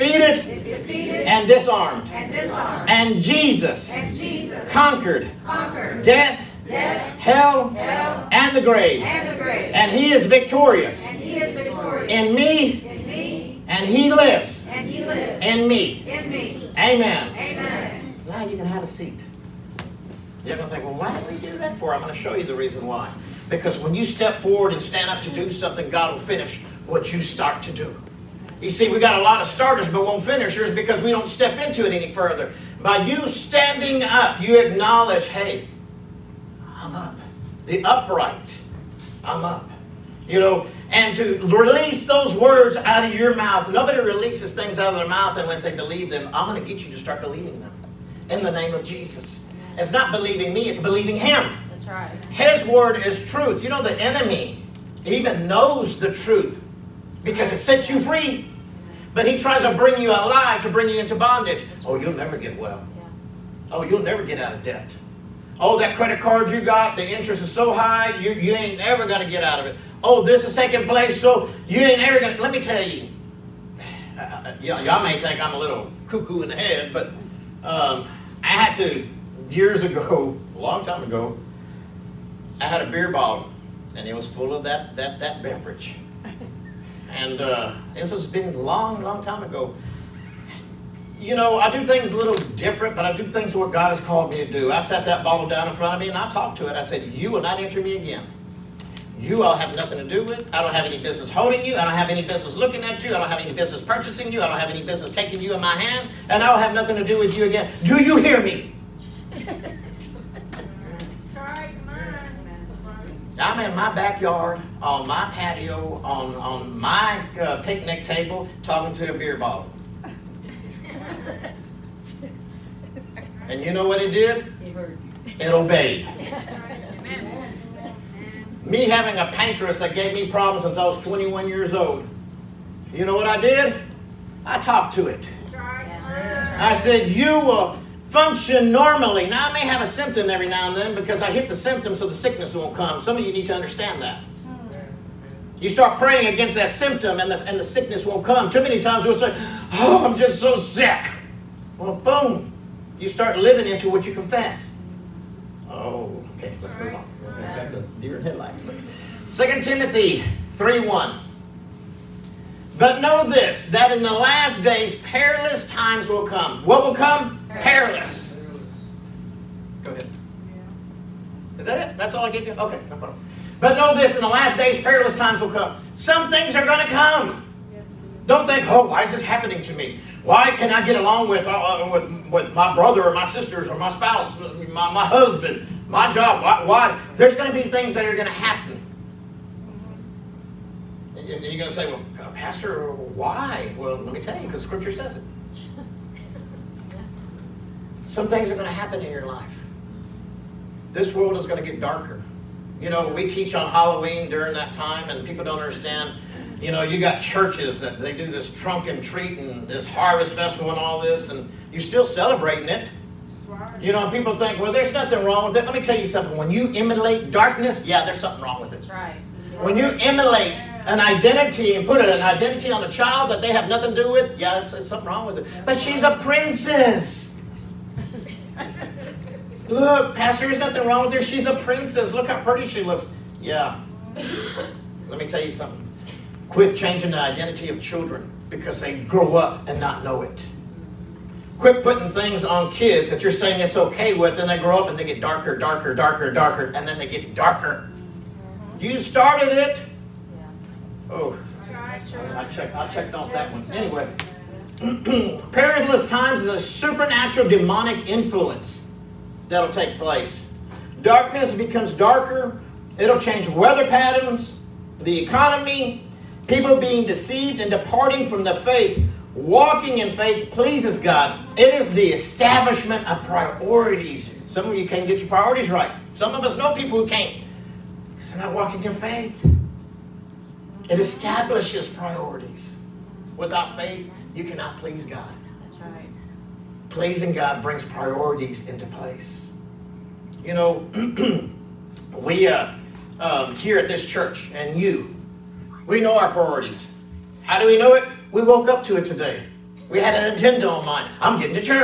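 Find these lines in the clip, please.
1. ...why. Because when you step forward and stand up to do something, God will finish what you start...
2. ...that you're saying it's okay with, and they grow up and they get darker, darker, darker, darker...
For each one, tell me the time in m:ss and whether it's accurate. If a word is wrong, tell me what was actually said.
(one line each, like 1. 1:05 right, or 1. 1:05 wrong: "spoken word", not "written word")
1. 0:22 right
2. 4:03 right.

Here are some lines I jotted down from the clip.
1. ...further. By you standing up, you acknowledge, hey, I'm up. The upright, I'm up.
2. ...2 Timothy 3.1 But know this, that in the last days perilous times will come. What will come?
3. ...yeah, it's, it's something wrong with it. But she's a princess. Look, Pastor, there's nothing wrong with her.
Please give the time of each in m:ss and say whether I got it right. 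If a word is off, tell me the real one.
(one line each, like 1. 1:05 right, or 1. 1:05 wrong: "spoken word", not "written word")
1. 0:32 right
2. 2:39 right
3. 3:44 right.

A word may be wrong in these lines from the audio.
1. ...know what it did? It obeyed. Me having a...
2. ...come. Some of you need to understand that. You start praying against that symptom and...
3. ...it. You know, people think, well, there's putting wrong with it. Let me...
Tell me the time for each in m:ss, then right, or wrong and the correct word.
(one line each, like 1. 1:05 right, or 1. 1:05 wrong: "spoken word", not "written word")
1. 2:03 right
2. 2:22 right
3. 3:32 wrong: "nothing", not "putting".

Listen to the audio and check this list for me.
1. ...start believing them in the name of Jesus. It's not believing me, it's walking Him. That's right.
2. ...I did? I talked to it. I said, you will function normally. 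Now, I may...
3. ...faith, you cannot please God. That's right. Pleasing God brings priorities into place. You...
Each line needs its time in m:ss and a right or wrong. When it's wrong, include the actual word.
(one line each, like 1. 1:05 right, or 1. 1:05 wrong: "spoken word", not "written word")
1. 0:46 wrong: "believing", not "walking"
2. 2:13 right
3. 4:43 right.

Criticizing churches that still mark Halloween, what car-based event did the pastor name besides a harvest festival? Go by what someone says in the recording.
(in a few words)
trunk and treat.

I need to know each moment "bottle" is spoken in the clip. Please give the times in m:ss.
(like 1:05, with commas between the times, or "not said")
1:23, 1:35, 1:59.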